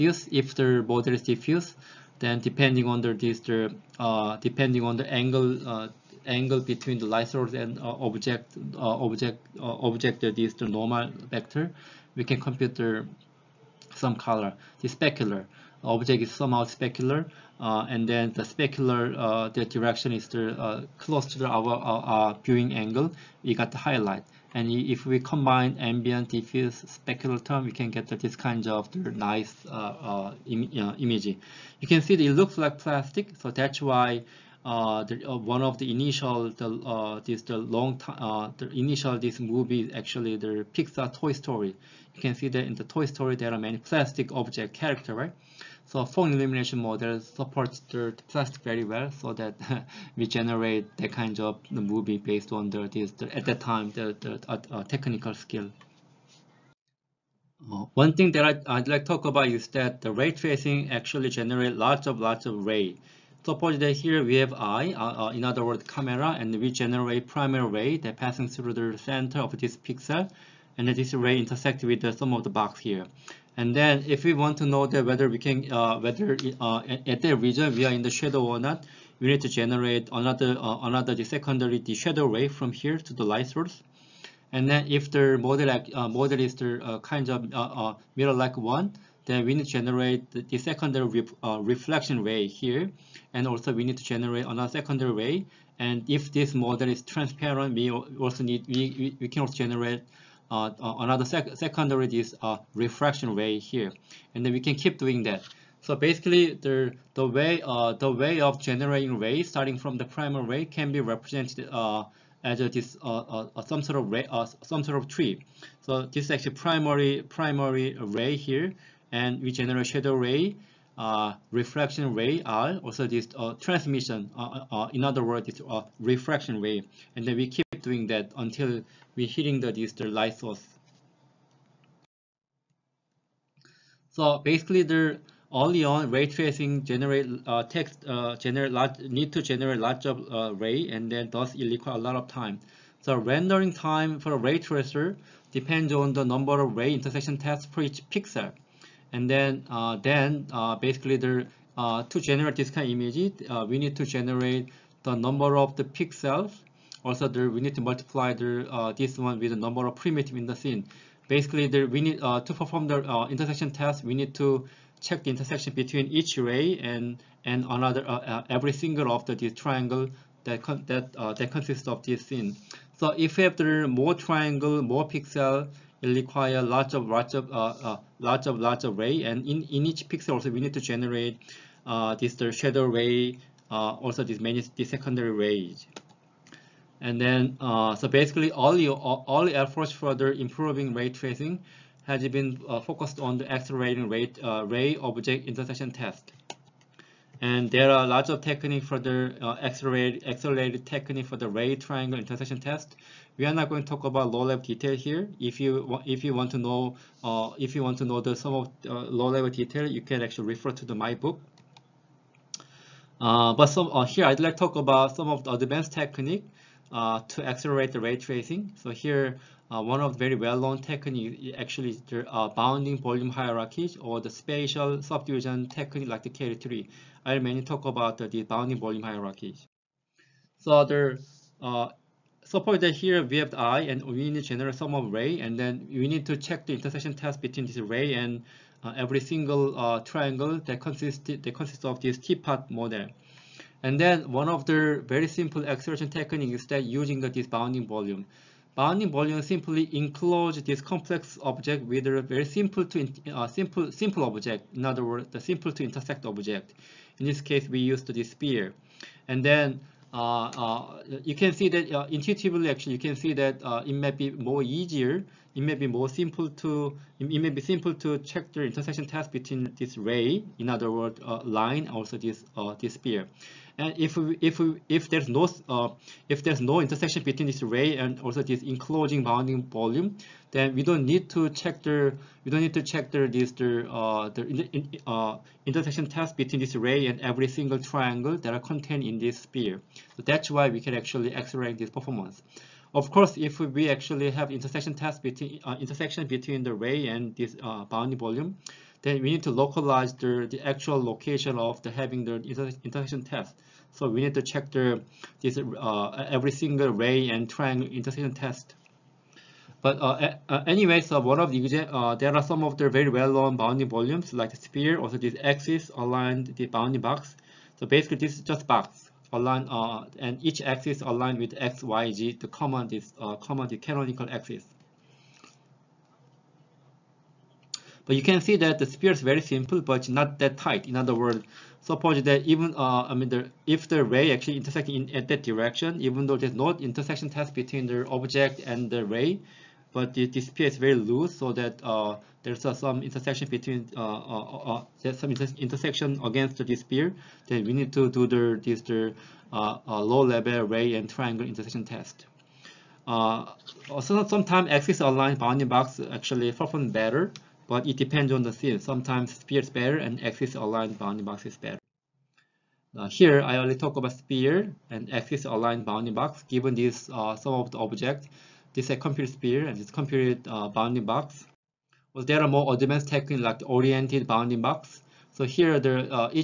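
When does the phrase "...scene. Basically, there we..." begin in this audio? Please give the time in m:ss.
2:40.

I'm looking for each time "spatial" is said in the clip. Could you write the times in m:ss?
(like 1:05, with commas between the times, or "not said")
3:44.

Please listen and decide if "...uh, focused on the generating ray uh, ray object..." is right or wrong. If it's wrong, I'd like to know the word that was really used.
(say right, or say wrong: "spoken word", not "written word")
wrong: "accelerating", not "generating".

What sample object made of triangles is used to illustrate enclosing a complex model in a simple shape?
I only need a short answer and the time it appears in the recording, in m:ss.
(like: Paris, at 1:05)
teapot, at 4:02.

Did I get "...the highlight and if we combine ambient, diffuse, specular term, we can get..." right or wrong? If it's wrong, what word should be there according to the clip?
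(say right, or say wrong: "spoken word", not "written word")
right.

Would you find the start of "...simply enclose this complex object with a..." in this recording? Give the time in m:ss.
4:09.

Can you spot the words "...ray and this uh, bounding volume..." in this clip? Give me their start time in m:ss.
4:56.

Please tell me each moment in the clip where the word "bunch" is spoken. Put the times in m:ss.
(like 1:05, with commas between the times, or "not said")
not said.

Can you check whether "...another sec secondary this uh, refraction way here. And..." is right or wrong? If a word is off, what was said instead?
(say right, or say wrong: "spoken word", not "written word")
right.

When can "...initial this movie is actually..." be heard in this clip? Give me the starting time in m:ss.
0:38.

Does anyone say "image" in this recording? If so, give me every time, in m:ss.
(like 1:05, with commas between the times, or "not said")
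0:30, 2:32.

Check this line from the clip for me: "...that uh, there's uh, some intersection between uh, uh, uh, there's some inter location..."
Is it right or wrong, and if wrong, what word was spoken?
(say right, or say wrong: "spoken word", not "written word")
wrong: "intersection", not "location".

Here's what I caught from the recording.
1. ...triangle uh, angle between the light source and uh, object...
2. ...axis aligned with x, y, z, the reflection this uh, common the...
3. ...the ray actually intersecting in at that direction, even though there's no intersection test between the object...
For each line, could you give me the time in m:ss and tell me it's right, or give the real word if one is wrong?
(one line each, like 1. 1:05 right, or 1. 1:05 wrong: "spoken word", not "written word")
1. 0:05 wrong: "angle", not "triangle"
2. 5:20 wrong: "common", not "reflection"
3. 5:33 right.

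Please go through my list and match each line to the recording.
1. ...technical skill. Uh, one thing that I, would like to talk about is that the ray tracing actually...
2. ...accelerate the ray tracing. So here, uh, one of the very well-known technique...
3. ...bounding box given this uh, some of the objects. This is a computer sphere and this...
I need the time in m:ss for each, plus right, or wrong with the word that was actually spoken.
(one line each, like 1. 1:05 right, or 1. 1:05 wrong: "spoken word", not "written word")
1. 0:54 right
2. 3:37 right
3. 6:05 right.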